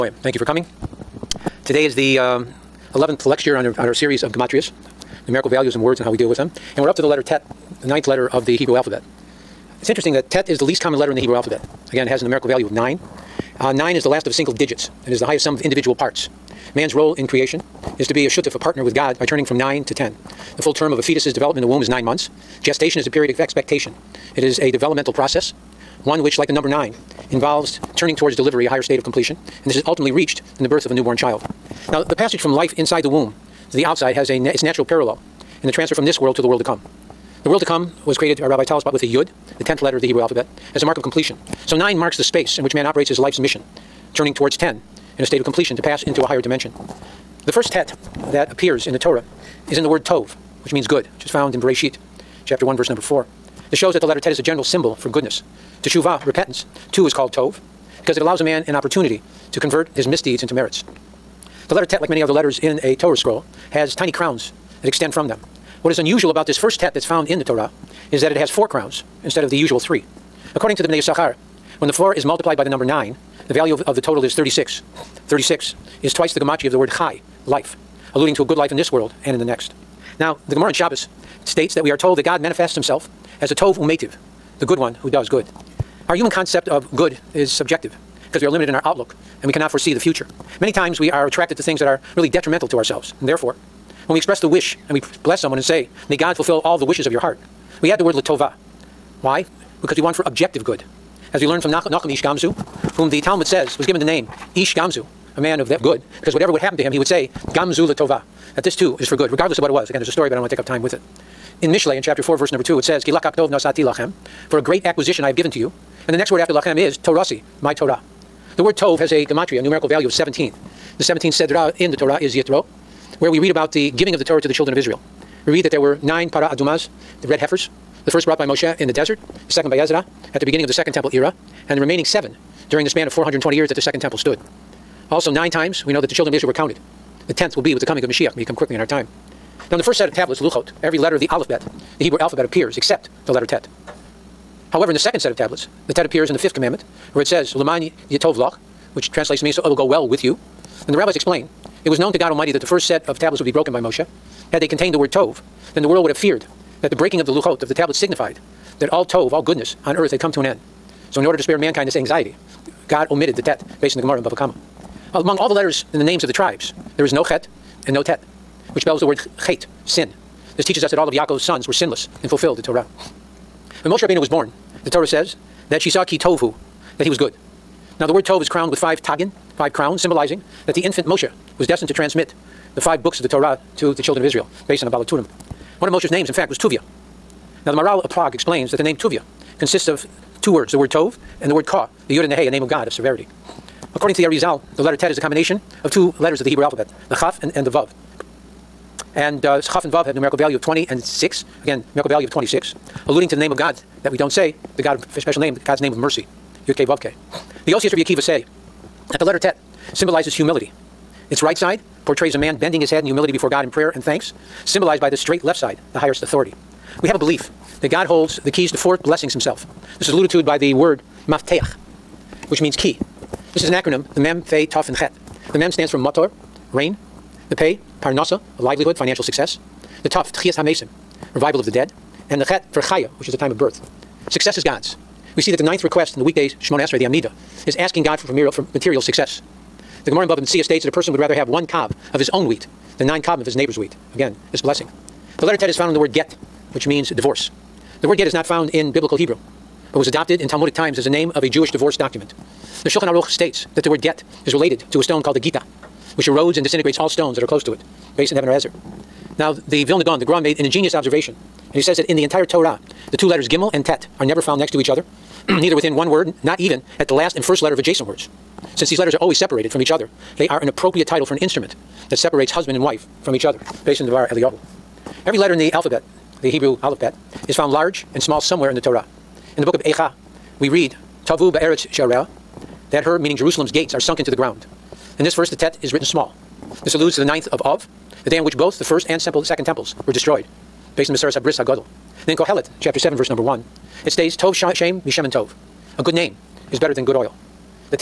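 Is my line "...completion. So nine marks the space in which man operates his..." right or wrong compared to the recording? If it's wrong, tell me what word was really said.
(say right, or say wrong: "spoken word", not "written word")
right.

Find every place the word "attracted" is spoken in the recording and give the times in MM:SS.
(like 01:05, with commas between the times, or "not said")
01:31.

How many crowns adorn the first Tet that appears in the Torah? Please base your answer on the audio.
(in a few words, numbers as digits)
4.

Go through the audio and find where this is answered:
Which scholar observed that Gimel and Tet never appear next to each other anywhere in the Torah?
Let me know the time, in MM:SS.
04:19.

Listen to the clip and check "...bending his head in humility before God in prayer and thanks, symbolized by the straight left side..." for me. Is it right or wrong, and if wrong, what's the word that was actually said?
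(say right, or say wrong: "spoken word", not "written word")
right.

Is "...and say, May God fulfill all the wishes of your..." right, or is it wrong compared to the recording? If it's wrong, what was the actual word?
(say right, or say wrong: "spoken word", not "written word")
right.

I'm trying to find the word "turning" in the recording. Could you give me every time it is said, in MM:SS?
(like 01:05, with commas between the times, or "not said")
00:19, 00:27, 00:44.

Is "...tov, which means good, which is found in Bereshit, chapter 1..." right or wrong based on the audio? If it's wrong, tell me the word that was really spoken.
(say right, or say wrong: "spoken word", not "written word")
right.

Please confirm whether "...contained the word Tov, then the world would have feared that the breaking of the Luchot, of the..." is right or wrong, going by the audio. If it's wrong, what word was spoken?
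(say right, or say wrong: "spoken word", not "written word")
right.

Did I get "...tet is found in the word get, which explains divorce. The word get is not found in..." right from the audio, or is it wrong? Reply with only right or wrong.
wrong.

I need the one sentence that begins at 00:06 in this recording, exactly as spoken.
And we're up to the letter Tet, the ninth letter of the Hebrew alphabet.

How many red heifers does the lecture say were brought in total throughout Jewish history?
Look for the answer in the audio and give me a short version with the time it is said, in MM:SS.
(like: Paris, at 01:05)
9, at 02:06.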